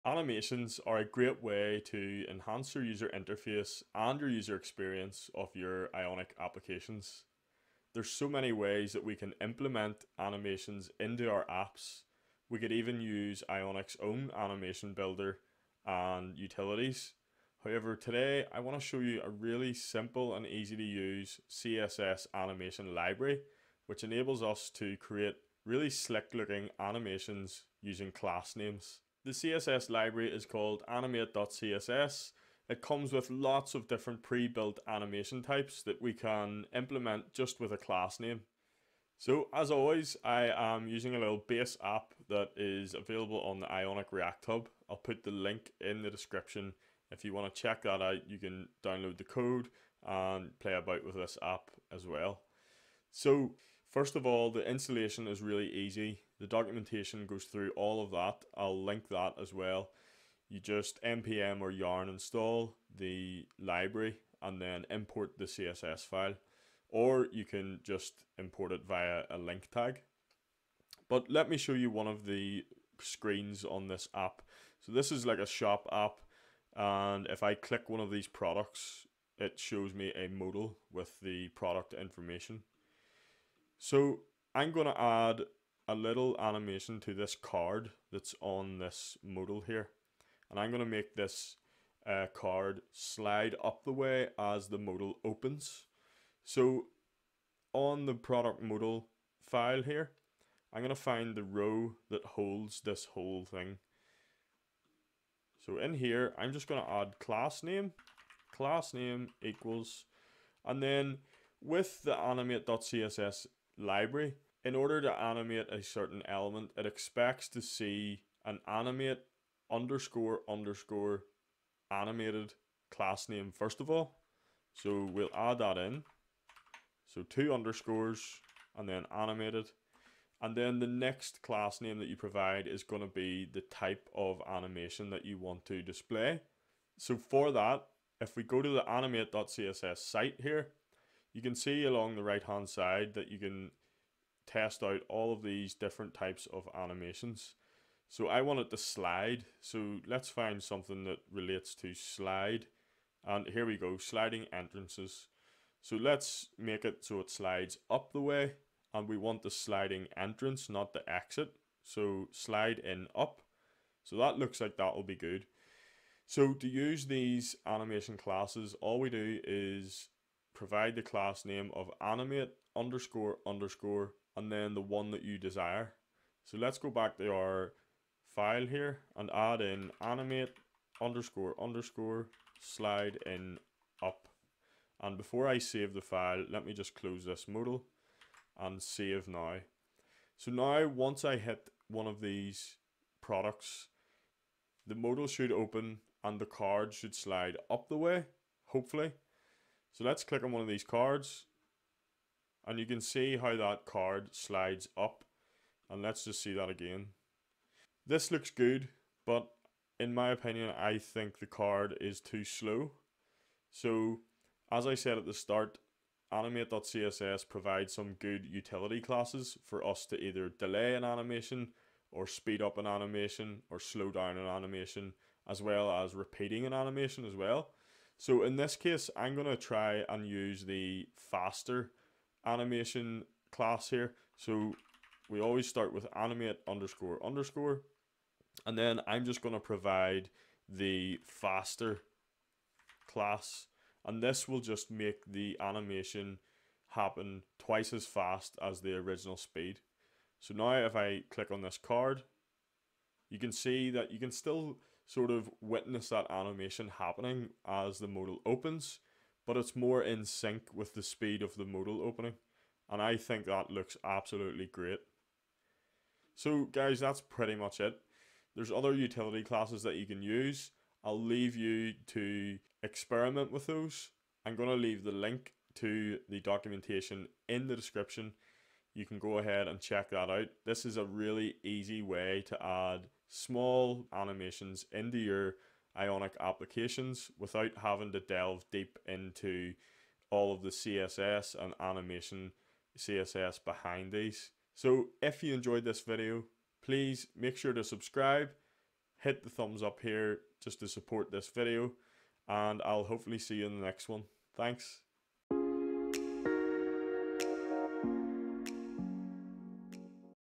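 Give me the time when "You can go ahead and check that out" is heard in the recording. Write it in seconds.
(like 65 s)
278 s.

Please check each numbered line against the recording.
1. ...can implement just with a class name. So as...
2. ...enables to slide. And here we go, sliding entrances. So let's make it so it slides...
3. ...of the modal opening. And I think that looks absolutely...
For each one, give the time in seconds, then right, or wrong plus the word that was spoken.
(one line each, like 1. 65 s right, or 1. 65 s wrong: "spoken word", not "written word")
1. 36 s right
2. 151 s wrong: "relates", not "enables"
3. 261 s right.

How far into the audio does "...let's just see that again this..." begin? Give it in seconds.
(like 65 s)
206 s.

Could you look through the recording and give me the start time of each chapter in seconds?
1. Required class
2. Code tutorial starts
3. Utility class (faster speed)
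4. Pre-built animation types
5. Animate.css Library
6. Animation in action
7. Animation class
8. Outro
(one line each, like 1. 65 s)
1. 110 s
2. 41 s
3. 228 s
4. 138 s
5. 29 s
6. 189 s
7. 178 s
8. 294 s.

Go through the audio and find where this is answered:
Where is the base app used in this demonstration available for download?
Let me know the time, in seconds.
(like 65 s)
43 s.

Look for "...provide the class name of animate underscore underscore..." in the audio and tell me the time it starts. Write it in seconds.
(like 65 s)
170 s.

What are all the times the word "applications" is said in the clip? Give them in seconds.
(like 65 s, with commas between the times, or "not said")
6 s, 286 s.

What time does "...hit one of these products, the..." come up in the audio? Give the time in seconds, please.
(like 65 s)
191 s.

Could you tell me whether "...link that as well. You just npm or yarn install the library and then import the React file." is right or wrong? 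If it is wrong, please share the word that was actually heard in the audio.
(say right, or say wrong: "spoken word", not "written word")
wrong: "CSS", not "React".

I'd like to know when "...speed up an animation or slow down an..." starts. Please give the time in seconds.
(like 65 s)
222 s.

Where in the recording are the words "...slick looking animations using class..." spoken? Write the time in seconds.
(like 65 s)
25 s.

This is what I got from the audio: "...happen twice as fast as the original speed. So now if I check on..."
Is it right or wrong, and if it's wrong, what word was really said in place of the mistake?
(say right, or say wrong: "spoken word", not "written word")
wrong: "click", not "check".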